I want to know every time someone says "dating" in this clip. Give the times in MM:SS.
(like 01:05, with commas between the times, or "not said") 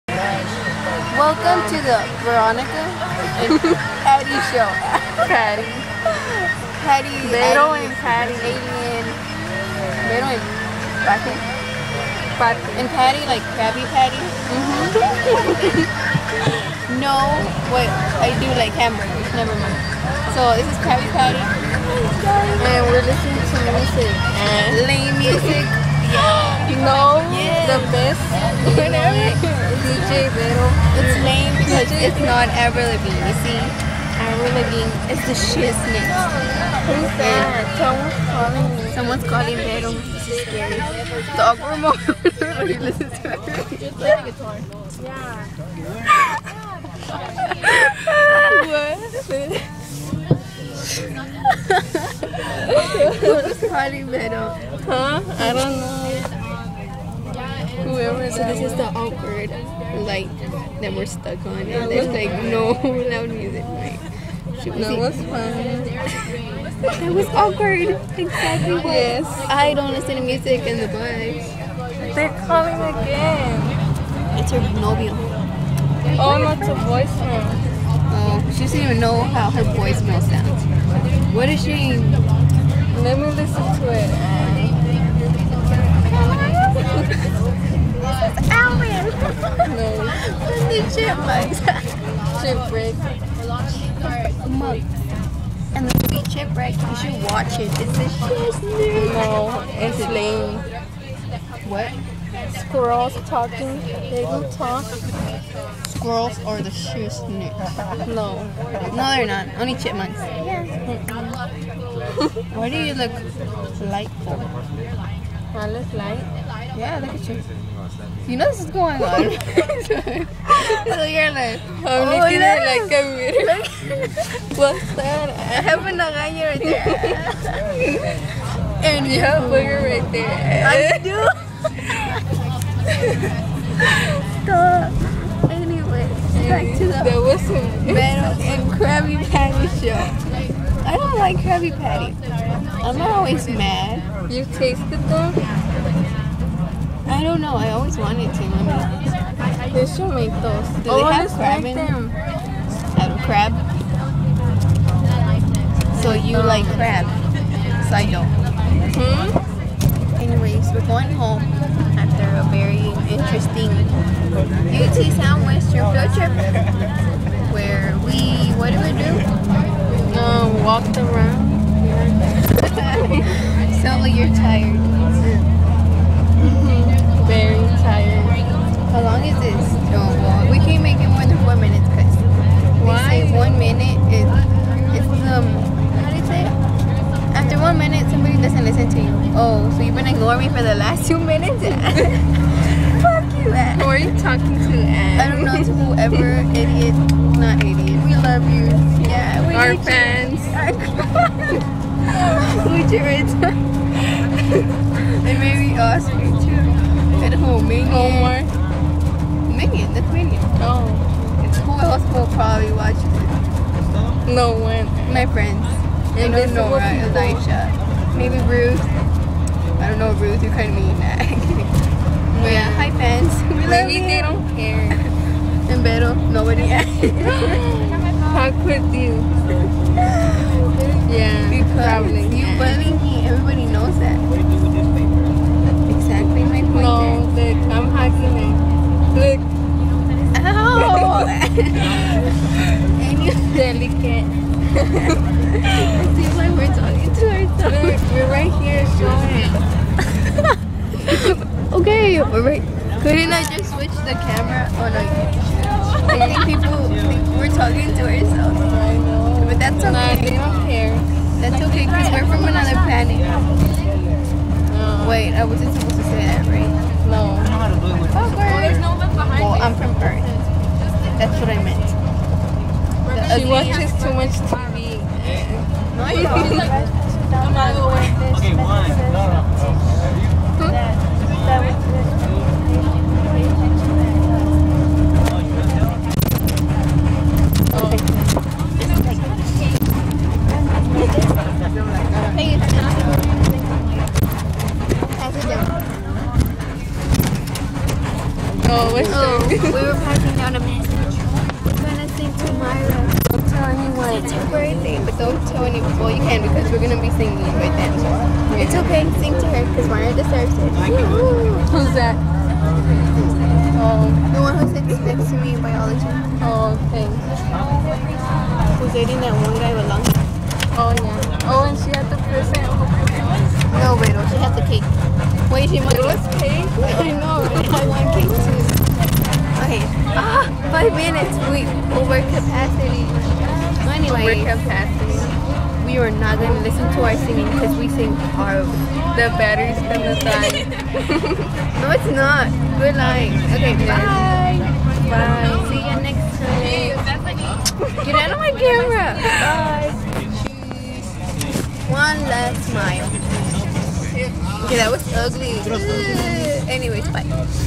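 05:18.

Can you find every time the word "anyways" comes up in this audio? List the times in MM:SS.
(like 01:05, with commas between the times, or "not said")
02:15, 02:40, 05:56.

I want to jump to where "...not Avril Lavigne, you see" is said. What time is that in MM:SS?
00:32.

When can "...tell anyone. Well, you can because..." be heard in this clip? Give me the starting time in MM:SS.
05:05.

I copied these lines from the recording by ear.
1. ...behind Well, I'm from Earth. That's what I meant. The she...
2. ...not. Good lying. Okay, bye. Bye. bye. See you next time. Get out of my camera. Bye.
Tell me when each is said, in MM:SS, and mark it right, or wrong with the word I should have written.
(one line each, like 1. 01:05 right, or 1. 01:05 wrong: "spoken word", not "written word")
1. 04:29 right
2. 05:42 right.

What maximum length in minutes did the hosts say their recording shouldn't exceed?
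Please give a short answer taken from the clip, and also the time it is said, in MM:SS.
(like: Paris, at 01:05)
4, at 03:01.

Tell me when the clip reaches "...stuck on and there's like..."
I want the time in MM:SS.
01:01.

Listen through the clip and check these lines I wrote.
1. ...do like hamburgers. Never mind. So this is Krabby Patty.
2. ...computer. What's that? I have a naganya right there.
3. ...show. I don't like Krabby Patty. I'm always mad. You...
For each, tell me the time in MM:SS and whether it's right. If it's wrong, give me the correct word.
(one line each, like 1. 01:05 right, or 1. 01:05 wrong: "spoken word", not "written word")
1. 00:18 right
2. 02:03 right
3. 02:19 right.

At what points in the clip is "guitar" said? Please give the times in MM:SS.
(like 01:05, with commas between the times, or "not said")
00:44.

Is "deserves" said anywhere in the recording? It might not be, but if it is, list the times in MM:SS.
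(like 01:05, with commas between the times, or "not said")
05:10.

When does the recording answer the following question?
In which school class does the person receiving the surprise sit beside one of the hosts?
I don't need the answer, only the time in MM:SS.
05:15.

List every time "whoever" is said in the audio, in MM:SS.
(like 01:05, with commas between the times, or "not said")
03:15.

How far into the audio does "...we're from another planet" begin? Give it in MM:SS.
04:22.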